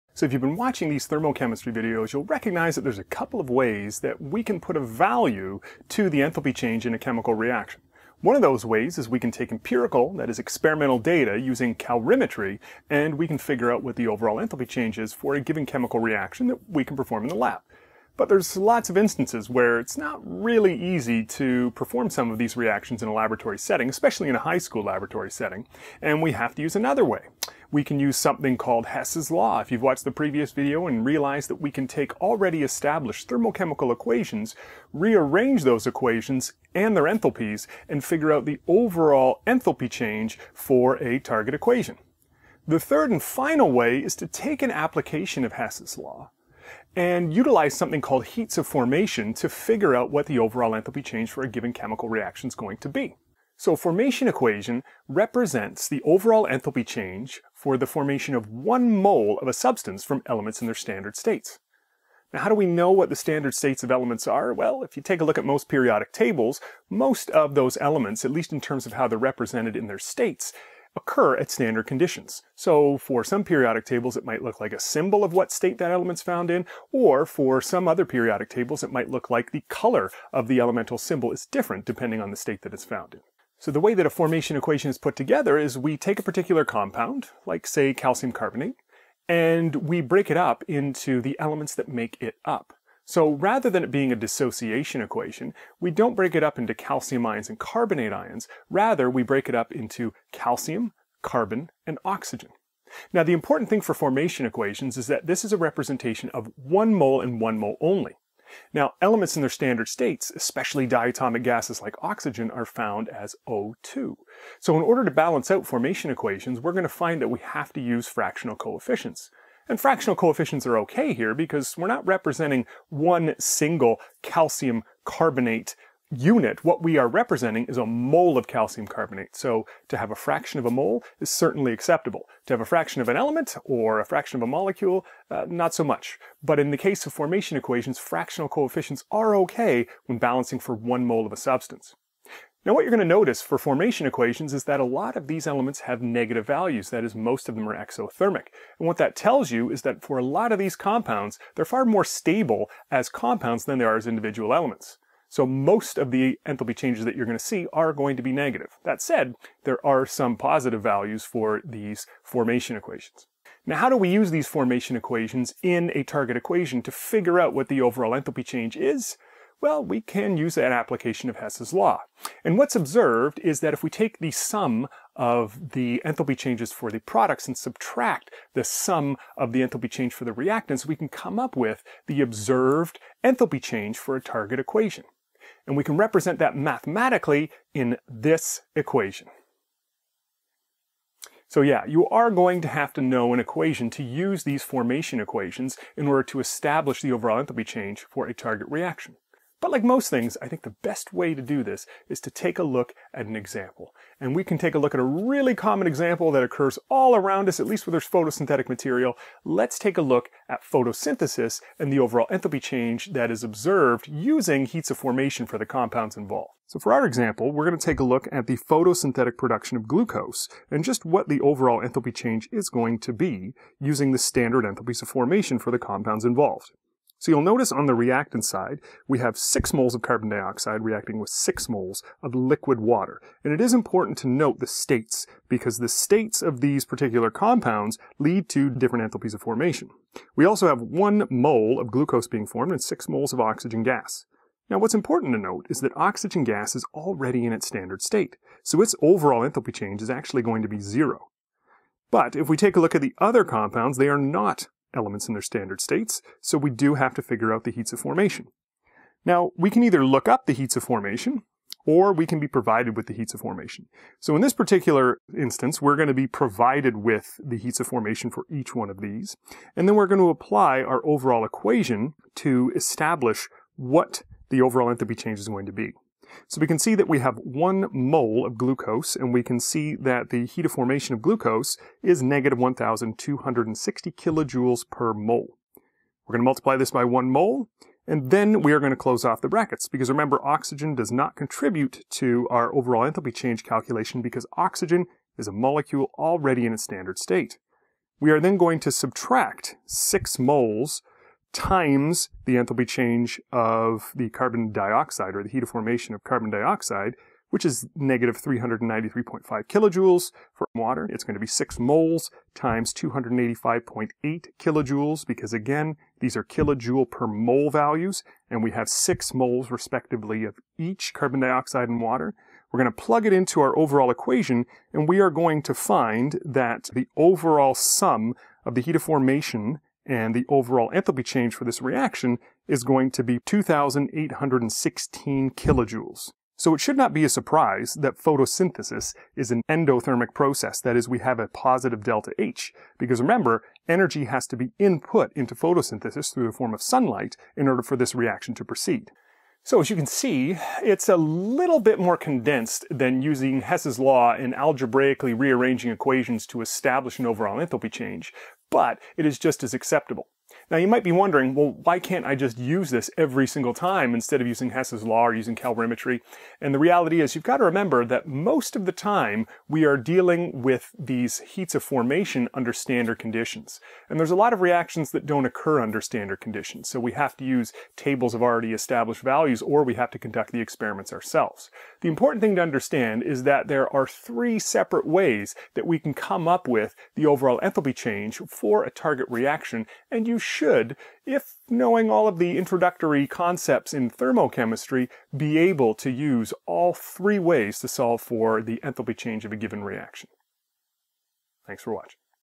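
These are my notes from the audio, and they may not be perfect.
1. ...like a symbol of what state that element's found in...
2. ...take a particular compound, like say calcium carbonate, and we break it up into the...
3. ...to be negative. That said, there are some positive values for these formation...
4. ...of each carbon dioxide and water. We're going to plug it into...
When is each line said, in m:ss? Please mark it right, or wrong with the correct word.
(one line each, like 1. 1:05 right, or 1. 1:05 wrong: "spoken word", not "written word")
1. 1:14 right
2. 1:25 right
3. 2:38 right
4. 5:20 right.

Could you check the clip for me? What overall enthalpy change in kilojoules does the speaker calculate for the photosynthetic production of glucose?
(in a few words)
2,816.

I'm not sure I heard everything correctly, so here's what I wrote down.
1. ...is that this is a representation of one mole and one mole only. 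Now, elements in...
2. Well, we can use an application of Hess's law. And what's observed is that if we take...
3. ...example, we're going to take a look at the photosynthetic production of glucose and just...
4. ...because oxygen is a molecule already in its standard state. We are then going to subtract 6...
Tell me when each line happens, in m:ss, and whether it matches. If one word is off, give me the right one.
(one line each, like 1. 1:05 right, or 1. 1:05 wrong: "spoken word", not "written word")
1. 1:44 right
2. 2:49 right
3. 3:37 right
4. 4:54 right.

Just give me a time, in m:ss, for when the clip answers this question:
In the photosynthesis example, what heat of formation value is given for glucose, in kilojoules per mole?
4:42.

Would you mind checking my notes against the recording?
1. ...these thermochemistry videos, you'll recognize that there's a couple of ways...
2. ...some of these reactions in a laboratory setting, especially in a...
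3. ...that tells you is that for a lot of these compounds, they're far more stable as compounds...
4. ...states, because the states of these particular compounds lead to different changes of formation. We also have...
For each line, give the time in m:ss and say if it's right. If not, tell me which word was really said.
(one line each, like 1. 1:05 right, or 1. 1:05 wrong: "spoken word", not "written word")
1. 0:00 right
2. 0:22 right
3. 2:28 right
4. 3:54 wrong: "enthalpies", not "changes".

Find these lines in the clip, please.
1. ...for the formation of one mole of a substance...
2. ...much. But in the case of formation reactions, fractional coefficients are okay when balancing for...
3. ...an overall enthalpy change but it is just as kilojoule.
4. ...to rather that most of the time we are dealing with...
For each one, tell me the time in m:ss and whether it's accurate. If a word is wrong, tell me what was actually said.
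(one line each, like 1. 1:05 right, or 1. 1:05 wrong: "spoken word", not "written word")
1. 0:57 right
2. 2:15 wrong: "equations", not "reactions"
3. 5:57 wrong: "acceptable", not "kilojoule"
4. 6:07 wrong: "remember", not "rather".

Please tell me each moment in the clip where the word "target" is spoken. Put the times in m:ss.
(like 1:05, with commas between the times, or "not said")
0:41, 2:46, 3:04, 3:18, 6:28.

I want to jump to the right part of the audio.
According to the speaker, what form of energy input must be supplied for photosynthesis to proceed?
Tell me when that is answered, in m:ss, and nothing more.
5:46.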